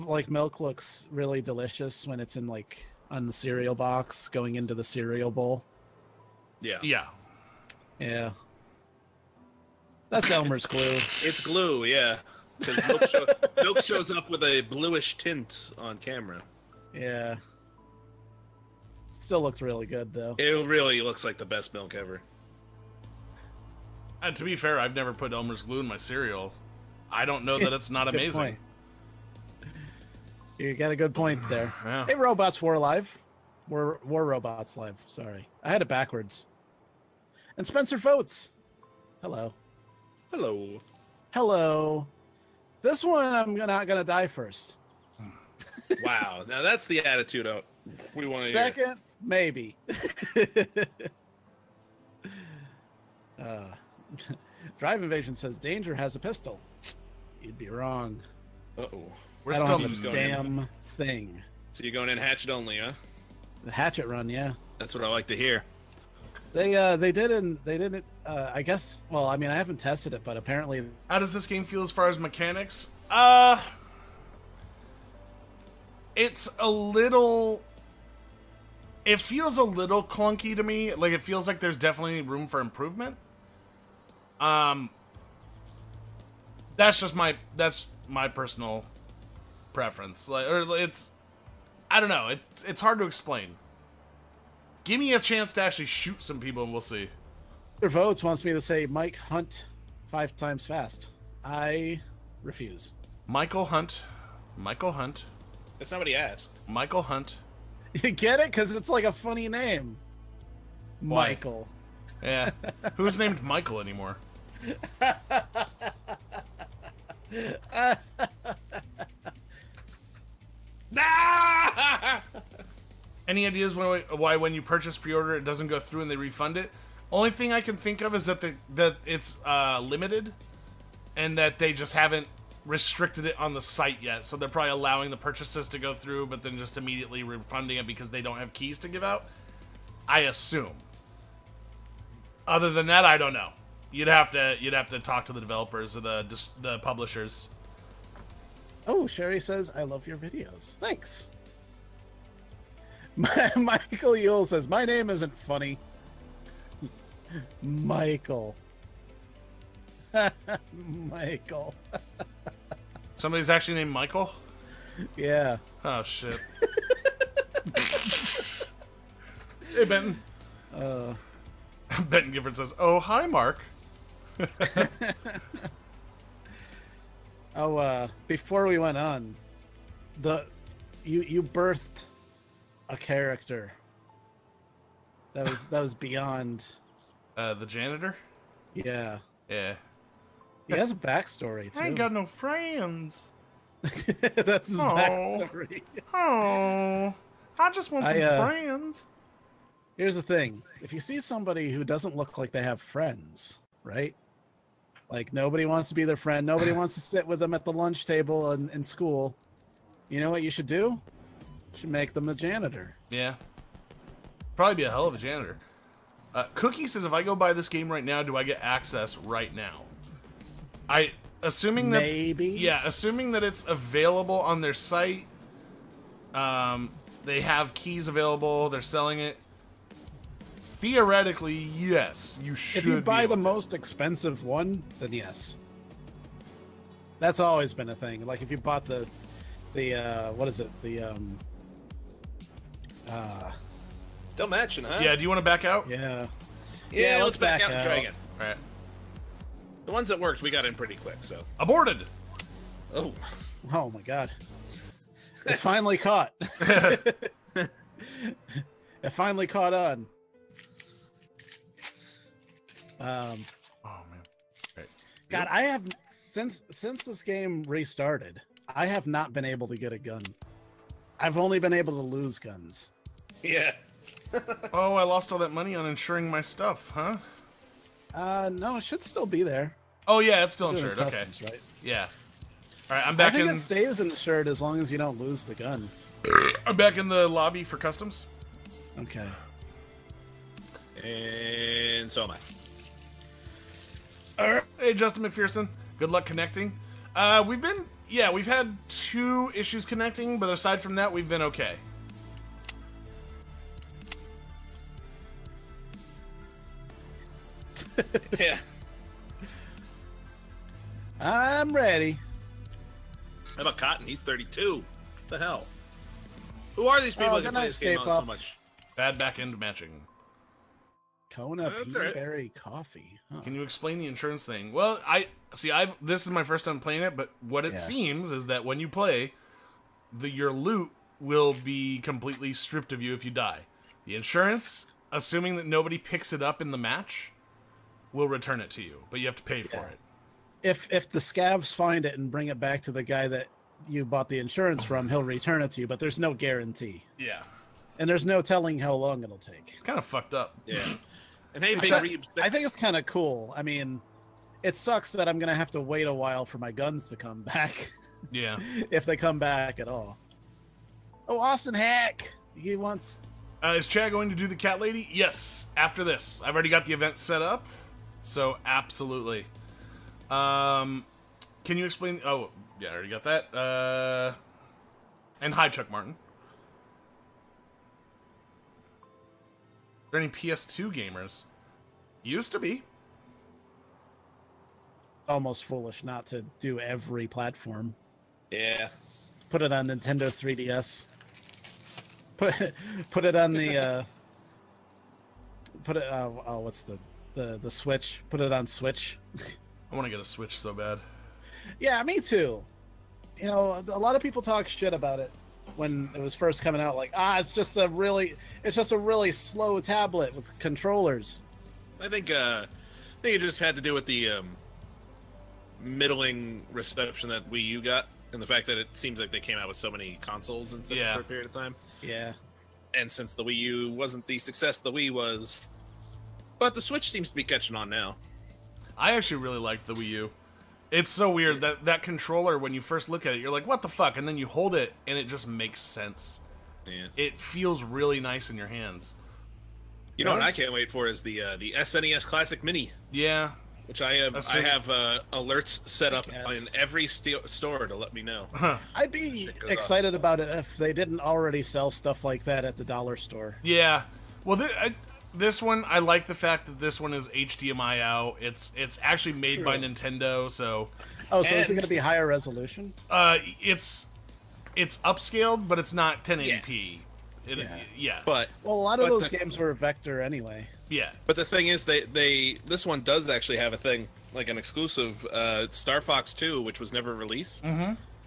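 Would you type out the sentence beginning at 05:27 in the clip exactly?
seems is that when you play, the your loot will be completely stripped of you if you die.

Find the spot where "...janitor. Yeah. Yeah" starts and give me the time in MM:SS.
03:07.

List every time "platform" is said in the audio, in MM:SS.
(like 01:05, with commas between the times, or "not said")
06:27.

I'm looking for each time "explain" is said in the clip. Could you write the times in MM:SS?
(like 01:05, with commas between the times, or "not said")
01:33, 05:23, 06:11.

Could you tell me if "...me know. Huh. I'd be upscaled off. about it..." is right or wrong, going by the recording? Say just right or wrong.
wrong.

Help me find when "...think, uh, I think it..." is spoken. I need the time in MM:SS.
06:52.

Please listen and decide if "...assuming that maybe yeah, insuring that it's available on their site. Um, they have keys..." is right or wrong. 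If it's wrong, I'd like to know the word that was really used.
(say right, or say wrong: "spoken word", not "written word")
wrong: "assuming", not "insuring".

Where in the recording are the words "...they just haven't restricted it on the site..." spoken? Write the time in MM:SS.
02:11.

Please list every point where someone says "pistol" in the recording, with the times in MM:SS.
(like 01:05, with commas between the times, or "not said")
00:56.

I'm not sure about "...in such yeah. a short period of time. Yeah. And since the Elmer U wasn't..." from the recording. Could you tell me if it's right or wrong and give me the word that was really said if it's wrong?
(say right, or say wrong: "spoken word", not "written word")
wrong: "Wii", not "Elmer".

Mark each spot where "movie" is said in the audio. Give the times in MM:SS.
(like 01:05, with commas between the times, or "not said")
not said.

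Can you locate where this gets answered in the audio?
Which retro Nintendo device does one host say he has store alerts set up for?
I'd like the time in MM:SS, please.
07:21.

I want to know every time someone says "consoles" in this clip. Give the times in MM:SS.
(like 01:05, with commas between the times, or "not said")
07:00.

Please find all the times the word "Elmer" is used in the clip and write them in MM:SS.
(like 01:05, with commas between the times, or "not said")
00:10, 00:25.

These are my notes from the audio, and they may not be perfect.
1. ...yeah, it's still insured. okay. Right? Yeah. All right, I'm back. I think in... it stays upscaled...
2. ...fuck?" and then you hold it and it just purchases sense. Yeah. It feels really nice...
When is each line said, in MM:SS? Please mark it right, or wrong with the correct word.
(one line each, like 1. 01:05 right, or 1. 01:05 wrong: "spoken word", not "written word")
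1. 04:40 wrong: "insured", not "upscaled"
2. 07:13 wrong: "makes", not "purchases".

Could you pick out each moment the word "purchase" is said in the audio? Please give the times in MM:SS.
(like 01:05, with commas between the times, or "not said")
02:04, 02:15.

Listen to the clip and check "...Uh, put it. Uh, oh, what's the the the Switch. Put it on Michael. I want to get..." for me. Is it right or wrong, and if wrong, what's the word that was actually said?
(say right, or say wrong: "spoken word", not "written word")
wrong: "Switch", not "Michael".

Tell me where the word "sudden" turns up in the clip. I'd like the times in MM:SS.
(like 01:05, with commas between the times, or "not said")
not said.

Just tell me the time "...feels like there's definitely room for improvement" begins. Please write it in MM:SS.
01:21.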